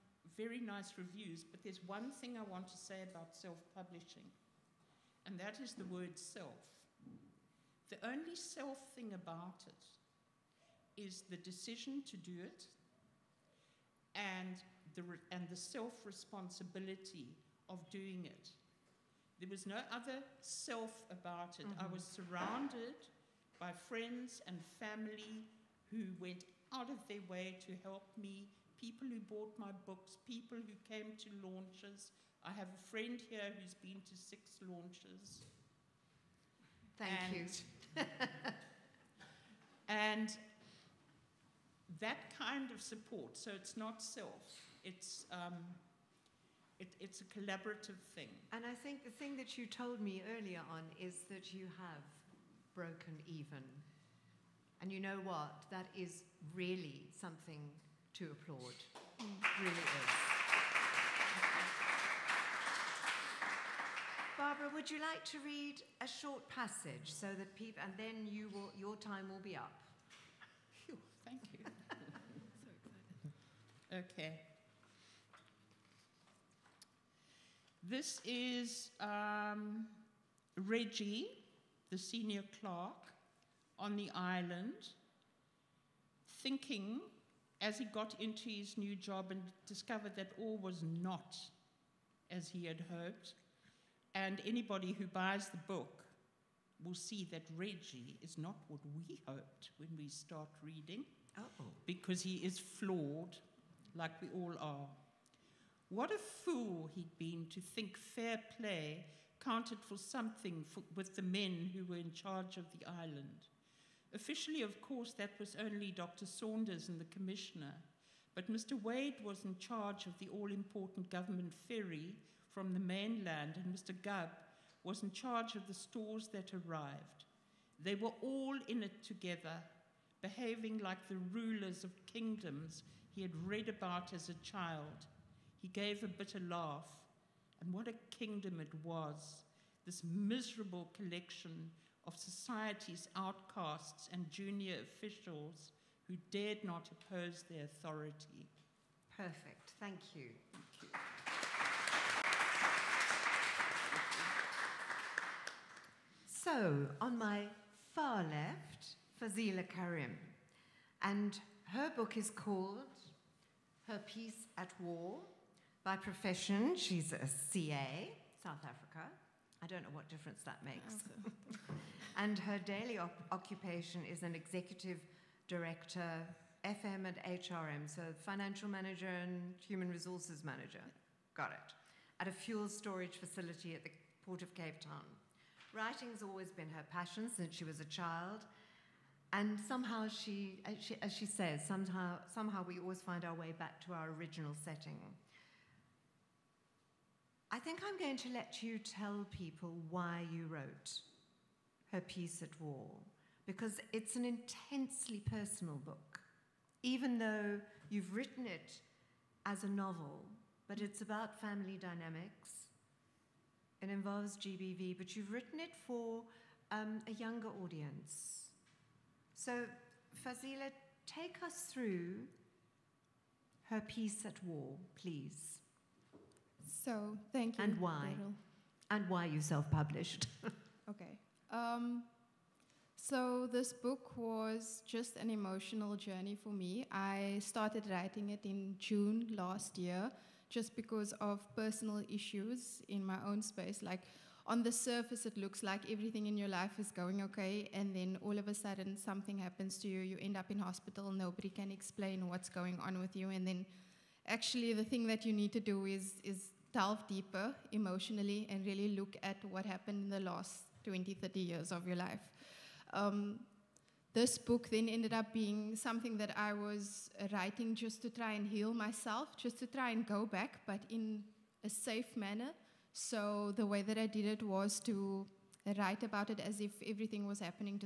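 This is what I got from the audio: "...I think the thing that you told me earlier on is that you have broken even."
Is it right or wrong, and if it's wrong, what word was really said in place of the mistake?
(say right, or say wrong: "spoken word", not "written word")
right.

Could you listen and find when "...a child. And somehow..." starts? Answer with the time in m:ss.
3:07.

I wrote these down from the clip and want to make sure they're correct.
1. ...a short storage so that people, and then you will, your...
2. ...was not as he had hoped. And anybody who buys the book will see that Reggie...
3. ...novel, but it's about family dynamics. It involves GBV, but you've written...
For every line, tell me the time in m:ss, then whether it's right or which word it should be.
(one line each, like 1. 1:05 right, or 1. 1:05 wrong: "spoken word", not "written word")
1. 1:06 wrong: "passage", not "storage"
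2. 1:30 right
3. 3:29 right.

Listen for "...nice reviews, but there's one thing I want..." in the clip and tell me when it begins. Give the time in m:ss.
0:00.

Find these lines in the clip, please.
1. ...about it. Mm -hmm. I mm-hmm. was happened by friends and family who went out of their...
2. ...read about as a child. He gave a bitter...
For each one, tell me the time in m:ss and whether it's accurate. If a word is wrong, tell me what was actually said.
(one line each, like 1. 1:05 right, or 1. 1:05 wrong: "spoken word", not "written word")
1. 0:21 wrong: "surrounded", not "happened"
2. 2:13 right.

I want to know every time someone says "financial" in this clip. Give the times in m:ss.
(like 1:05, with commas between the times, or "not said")
2:58.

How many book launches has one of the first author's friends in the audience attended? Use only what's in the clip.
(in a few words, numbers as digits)
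6.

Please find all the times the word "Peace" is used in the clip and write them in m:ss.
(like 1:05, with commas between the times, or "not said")
2:44, 3:21, 3:43.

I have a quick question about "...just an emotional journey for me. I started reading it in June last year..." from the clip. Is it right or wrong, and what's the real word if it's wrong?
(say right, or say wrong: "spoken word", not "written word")
wrong: "writing", not "reading".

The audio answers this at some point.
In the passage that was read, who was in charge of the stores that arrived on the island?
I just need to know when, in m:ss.
2:03.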